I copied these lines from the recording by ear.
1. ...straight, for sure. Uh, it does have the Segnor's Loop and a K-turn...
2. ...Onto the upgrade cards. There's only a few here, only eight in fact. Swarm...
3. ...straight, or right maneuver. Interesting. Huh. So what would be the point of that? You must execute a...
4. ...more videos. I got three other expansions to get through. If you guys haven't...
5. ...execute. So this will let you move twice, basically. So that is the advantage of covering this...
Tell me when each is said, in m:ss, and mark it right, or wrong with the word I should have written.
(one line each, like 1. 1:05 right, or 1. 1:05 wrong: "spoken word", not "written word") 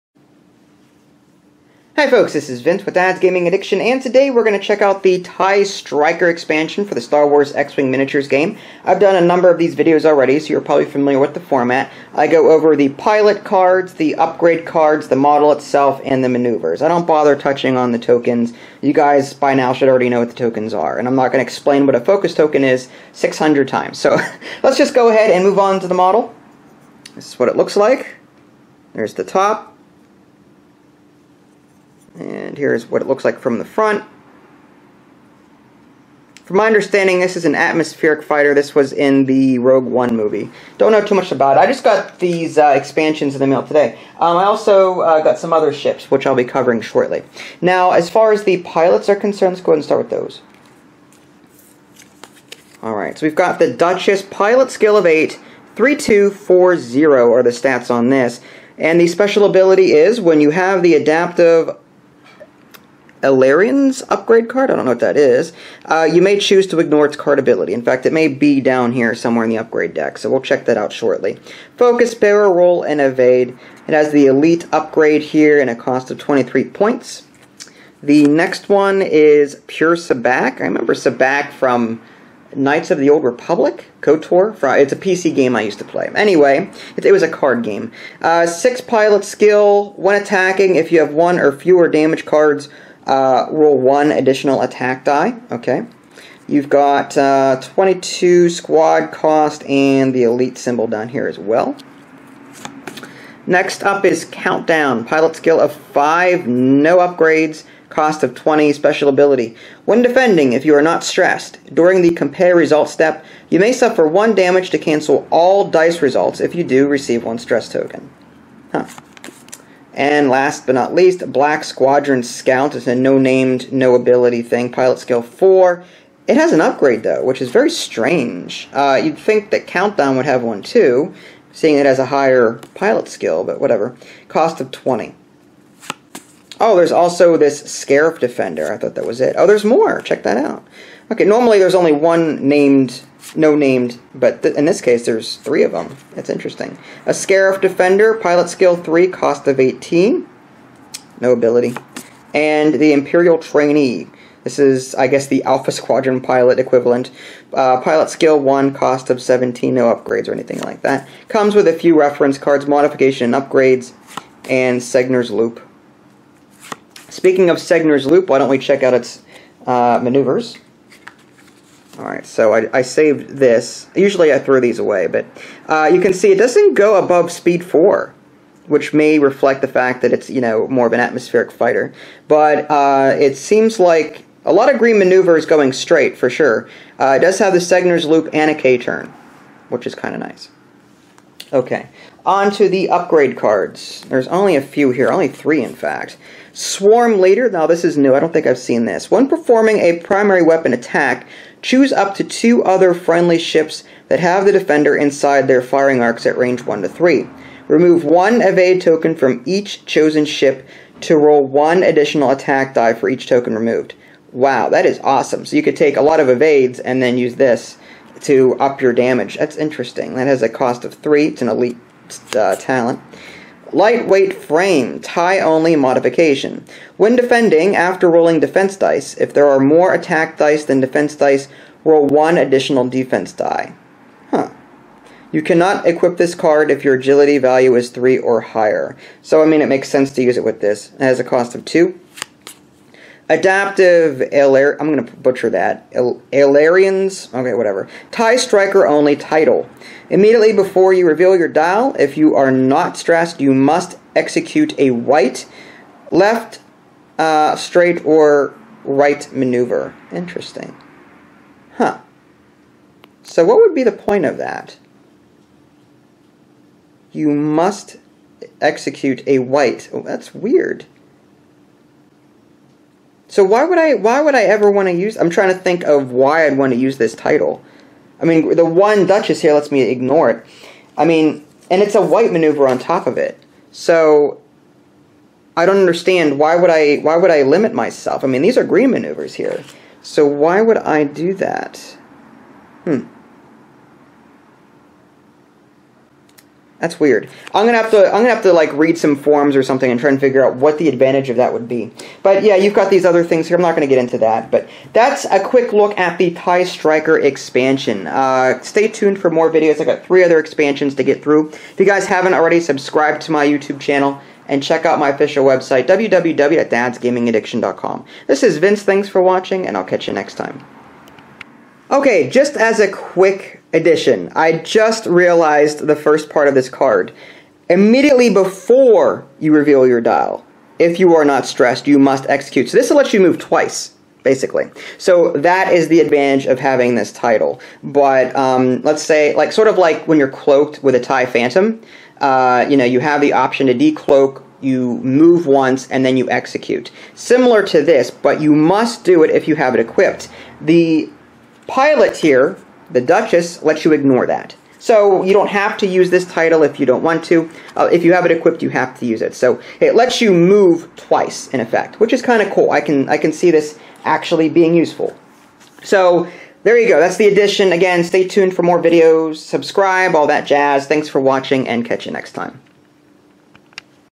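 1. 3:05 right
2. 3:12 wrong: "three", not "eight"
3. 4:17 right
4. 5:09 right
5. 5:32 wrong: "having", not "covering".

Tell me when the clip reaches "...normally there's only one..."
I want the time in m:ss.
2:21.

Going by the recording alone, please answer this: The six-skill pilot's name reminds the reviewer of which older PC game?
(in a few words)
Knights of the Old Republic.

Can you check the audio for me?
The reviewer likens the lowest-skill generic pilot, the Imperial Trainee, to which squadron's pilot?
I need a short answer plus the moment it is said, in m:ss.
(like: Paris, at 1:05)
Alpha Squadron, at 2:35.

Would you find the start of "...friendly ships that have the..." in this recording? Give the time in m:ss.
3:22.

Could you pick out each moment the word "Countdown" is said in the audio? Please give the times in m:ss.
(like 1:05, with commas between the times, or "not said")
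1:44, 2:09.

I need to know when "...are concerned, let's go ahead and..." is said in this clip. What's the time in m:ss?
0:49.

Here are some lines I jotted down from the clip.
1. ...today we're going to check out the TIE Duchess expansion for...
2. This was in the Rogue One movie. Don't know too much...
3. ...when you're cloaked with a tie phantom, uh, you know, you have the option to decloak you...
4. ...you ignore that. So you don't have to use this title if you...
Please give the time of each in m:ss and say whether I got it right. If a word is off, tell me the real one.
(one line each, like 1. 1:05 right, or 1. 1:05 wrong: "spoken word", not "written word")
1. 0:04 wrong: "Striker", not "Duchess"
2. 0:38 right
3. 5:40 right
4. 5:53 right.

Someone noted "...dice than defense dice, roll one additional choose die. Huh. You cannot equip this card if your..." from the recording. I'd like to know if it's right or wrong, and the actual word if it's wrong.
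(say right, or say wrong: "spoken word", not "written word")
wrong: "defense", not "choose".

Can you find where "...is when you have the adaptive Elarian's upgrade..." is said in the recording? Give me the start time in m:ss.
0:59.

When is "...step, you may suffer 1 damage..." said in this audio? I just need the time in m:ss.
1:52.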